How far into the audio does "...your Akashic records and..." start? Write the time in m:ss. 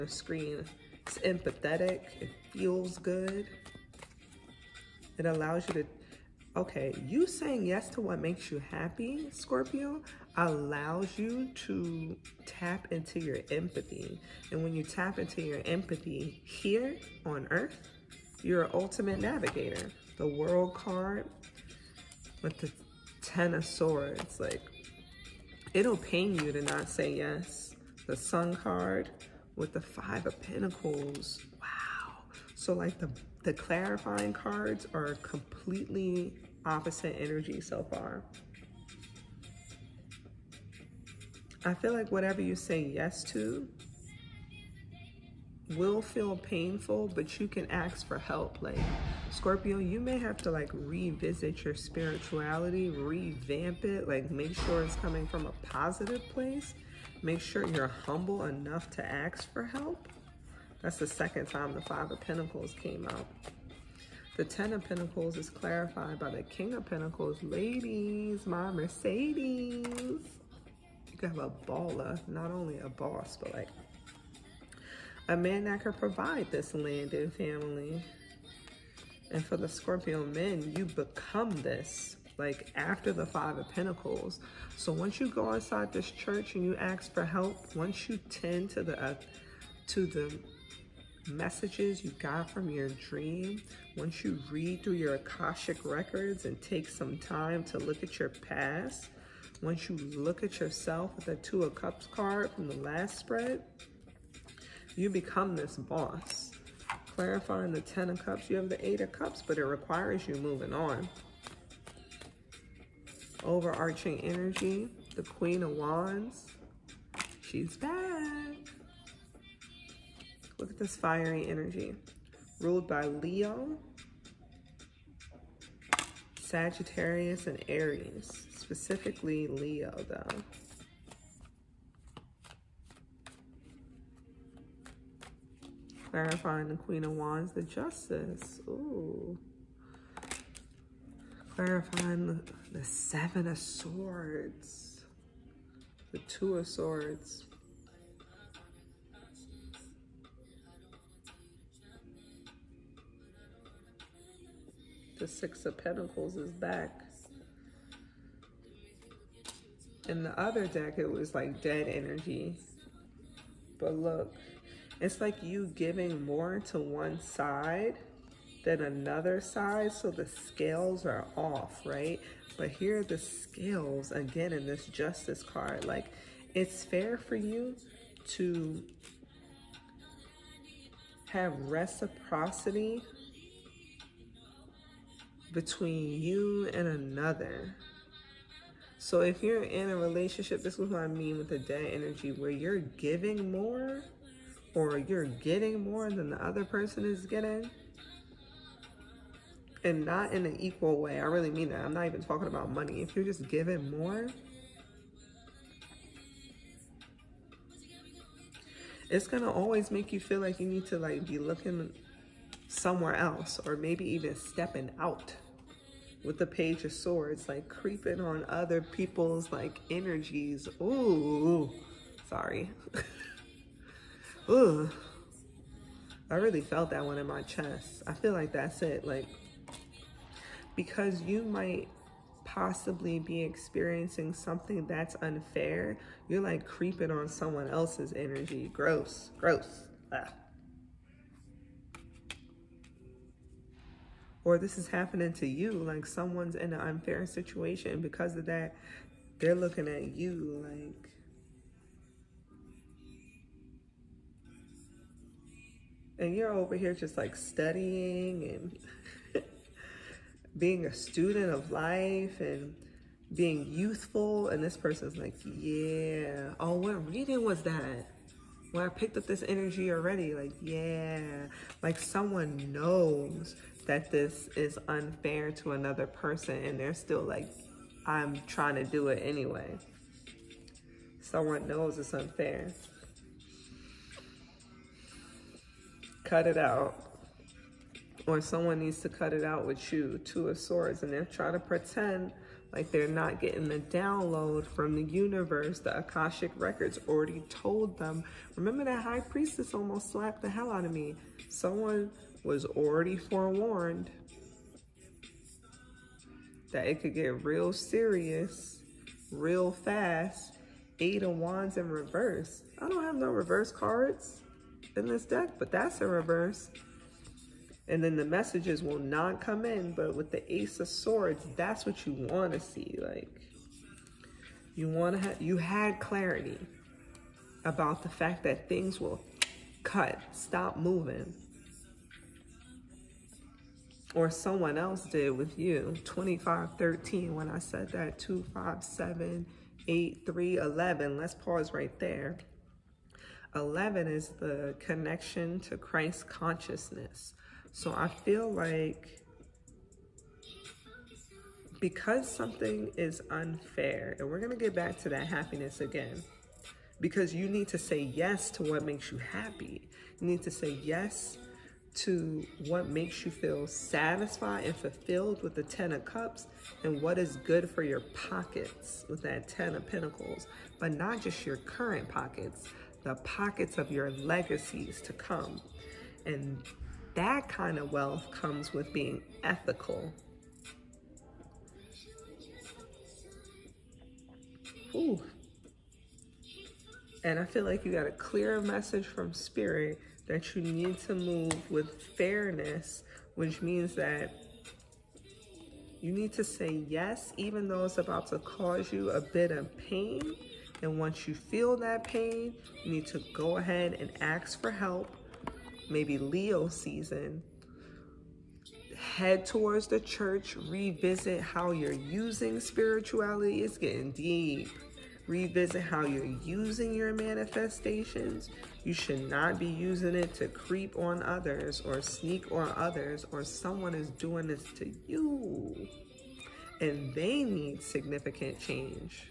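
1:34.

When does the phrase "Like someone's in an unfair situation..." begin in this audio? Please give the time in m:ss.
4:05.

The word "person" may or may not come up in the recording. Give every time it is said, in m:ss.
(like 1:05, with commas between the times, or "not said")
3:16, 4:24, 4:36.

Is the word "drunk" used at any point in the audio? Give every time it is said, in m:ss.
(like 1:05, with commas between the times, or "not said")
not said.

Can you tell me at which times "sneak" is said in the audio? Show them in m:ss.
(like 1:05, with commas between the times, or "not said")
7:02.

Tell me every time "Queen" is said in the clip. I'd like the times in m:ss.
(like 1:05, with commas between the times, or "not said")
1:55, 2:16.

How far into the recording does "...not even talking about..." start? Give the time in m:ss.
3:21.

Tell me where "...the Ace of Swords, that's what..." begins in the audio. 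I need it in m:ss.
5:20.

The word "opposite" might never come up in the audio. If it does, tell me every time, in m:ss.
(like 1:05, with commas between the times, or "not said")
0:36.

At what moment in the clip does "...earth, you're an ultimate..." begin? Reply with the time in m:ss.
0:17.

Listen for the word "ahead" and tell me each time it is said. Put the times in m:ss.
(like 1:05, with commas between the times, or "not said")
6:43.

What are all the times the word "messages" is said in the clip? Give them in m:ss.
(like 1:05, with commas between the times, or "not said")
1:31, 5:18, 6:28.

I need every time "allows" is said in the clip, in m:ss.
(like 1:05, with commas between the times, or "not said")
0:05, 0:10.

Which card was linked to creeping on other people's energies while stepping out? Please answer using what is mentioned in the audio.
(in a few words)
Page of Swords.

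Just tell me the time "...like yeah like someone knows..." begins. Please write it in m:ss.
4:30.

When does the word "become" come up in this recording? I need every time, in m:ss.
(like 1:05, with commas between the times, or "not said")
1:20, 1:45.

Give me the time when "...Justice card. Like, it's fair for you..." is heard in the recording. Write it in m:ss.
2:54.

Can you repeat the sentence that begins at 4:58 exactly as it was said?
Remember that High Priestess almost slapped the hell out of me.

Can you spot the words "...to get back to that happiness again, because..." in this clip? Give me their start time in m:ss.
5:54.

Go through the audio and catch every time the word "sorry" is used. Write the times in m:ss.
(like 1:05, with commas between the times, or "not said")
3:42.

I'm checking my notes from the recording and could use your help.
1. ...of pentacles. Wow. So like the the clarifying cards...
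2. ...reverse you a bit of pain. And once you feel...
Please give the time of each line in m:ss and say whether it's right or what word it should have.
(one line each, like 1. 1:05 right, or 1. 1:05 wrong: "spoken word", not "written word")
1. 0:30 right
2. 6:38 wrong: "cause", not "reverse".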